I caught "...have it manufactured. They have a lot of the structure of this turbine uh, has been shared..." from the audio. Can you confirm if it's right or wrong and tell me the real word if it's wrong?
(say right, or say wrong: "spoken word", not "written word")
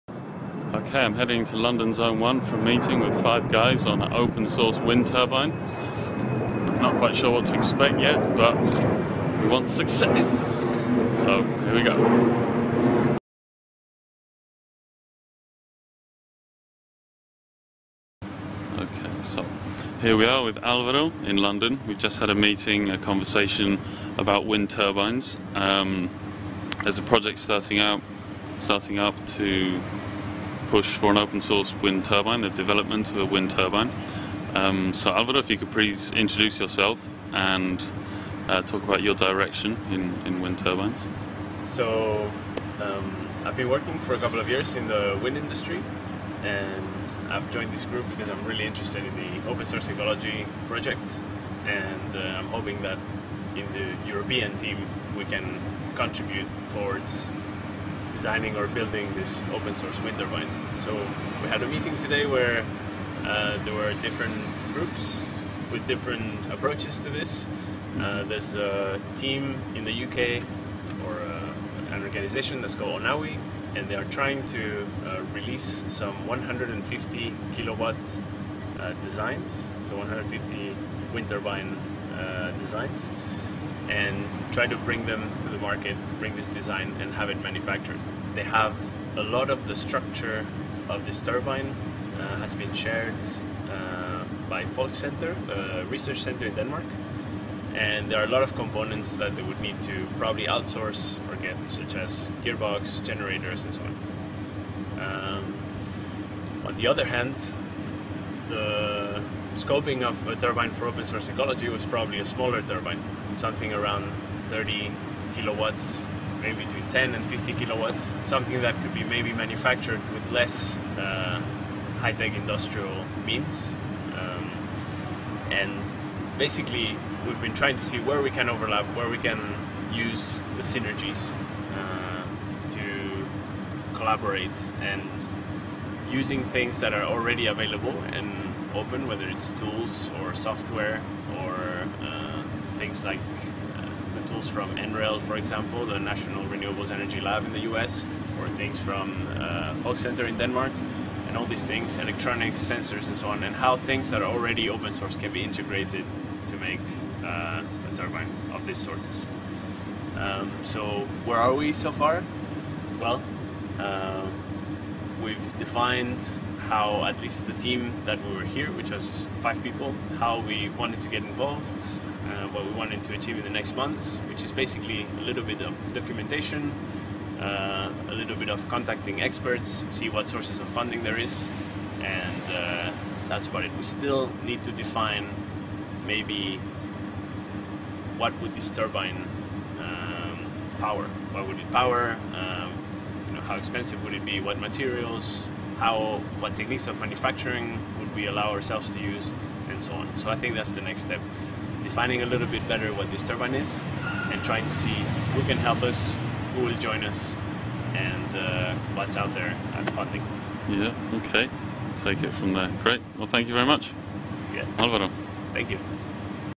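right.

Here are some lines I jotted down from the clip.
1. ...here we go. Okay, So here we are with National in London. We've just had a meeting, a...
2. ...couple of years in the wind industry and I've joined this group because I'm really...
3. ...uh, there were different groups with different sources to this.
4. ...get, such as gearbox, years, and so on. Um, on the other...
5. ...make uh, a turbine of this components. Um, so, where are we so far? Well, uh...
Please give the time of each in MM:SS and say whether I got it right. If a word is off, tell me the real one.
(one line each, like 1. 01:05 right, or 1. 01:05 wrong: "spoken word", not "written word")
1. 00:11 wrong: "Alvaro", not "National"
2. 00:44 right
3. 01:03 wrong: "approaches", not "sources"
4. 01:41 wrong: "generators", not "years"
5. 02:36 wrong: "sorts", not "components".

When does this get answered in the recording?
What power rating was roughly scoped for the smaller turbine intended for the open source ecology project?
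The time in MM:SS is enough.
01:54.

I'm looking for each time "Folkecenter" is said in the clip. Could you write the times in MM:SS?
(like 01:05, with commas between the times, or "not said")
01:34, 02:29.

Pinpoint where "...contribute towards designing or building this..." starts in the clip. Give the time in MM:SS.
00:55.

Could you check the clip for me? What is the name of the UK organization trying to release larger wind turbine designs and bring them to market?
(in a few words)
Onawi.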